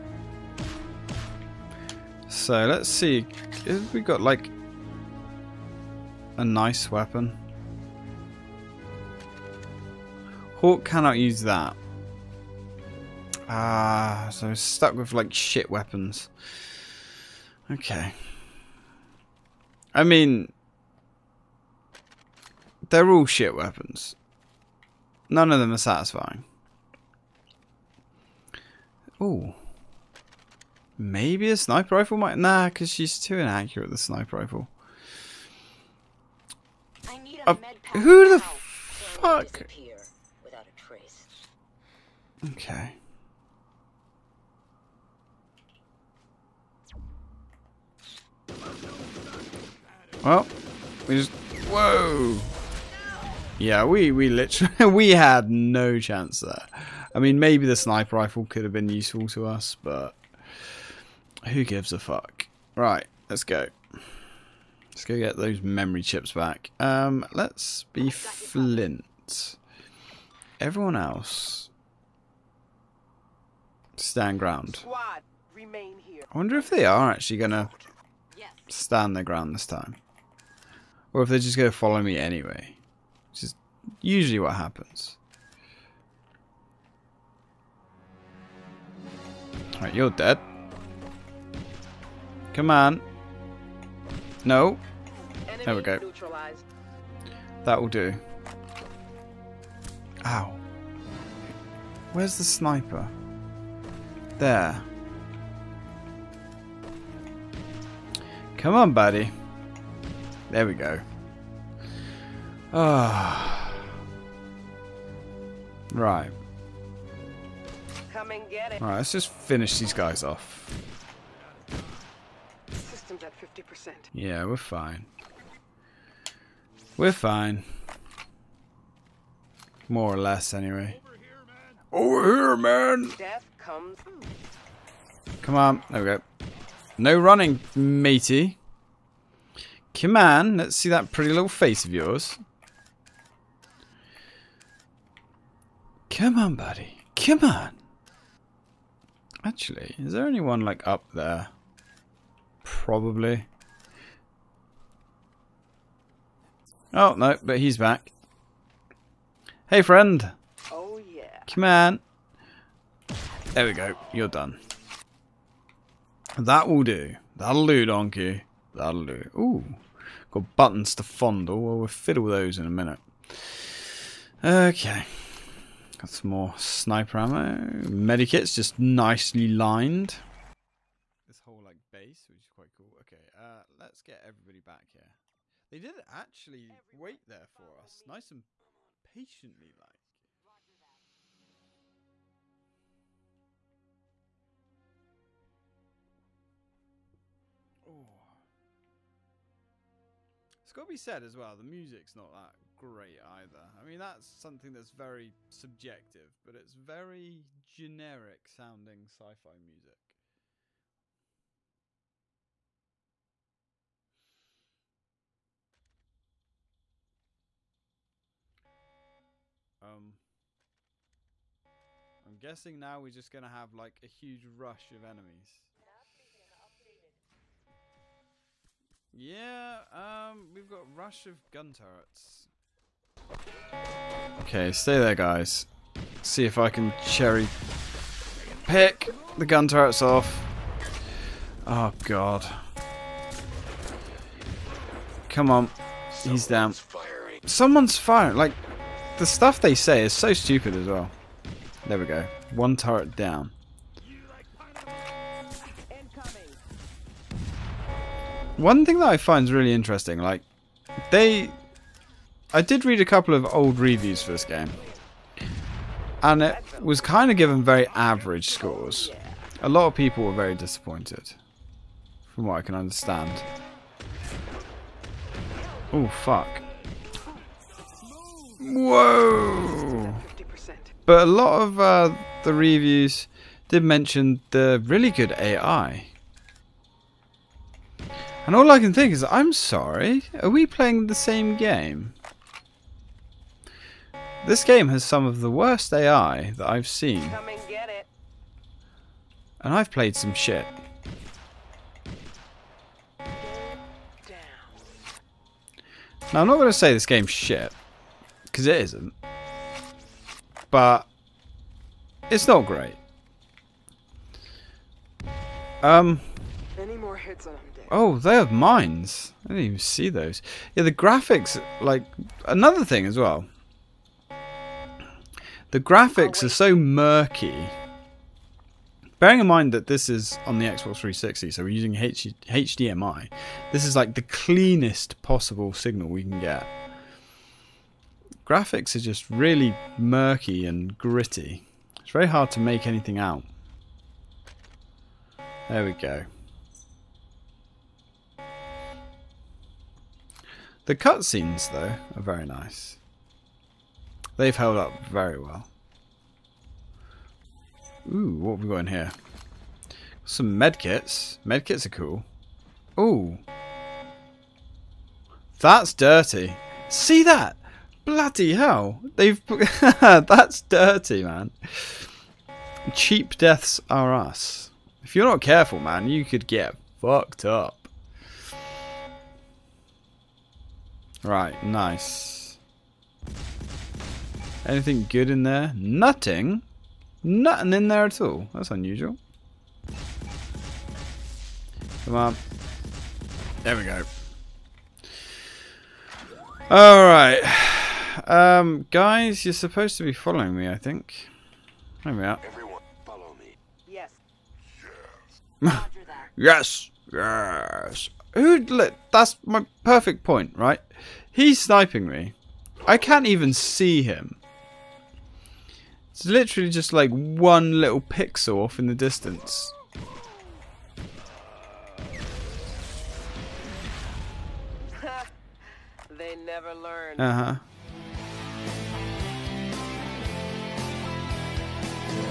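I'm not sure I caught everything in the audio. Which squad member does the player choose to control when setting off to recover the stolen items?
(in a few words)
Flint.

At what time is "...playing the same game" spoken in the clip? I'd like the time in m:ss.
4:50.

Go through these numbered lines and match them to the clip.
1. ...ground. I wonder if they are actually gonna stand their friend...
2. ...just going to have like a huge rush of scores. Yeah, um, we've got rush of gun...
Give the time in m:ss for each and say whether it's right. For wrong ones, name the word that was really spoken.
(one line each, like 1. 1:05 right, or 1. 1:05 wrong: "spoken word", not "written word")
1. 1:14 wrong: "ground", not "friend"
2. 3:43 wrong: "enemies", not "scores".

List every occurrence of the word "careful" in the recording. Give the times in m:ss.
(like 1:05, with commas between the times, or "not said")
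6:15.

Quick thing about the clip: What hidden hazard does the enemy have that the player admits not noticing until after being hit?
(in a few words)
mines.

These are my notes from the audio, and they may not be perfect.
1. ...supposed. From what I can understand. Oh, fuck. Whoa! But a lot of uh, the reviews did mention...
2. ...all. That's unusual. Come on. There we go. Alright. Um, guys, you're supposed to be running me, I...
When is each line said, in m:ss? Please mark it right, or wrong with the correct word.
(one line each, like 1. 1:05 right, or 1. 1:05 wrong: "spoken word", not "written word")
1. 4:30 wrong: "disappointed", not "supposed"
2. 6:28 wrong: "following", not "running".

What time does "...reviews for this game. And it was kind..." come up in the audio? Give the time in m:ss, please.
4:23.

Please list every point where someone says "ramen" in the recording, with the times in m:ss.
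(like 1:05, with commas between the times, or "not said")
not said.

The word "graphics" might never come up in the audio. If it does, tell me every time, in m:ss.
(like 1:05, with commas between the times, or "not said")
5:20, 5:25, 5:38.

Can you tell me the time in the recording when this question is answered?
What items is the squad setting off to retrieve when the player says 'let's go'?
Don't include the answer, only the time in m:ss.
1:05.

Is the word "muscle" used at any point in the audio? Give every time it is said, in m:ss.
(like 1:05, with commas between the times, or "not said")
not said.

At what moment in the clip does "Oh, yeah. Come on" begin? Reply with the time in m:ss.
2:40.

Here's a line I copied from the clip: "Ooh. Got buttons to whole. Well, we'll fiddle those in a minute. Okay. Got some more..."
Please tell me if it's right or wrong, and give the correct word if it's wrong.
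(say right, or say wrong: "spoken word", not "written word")
wrong: "fondle", not "whole".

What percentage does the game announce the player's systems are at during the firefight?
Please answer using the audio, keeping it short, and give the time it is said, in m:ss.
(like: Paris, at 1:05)
50%, at 2:03.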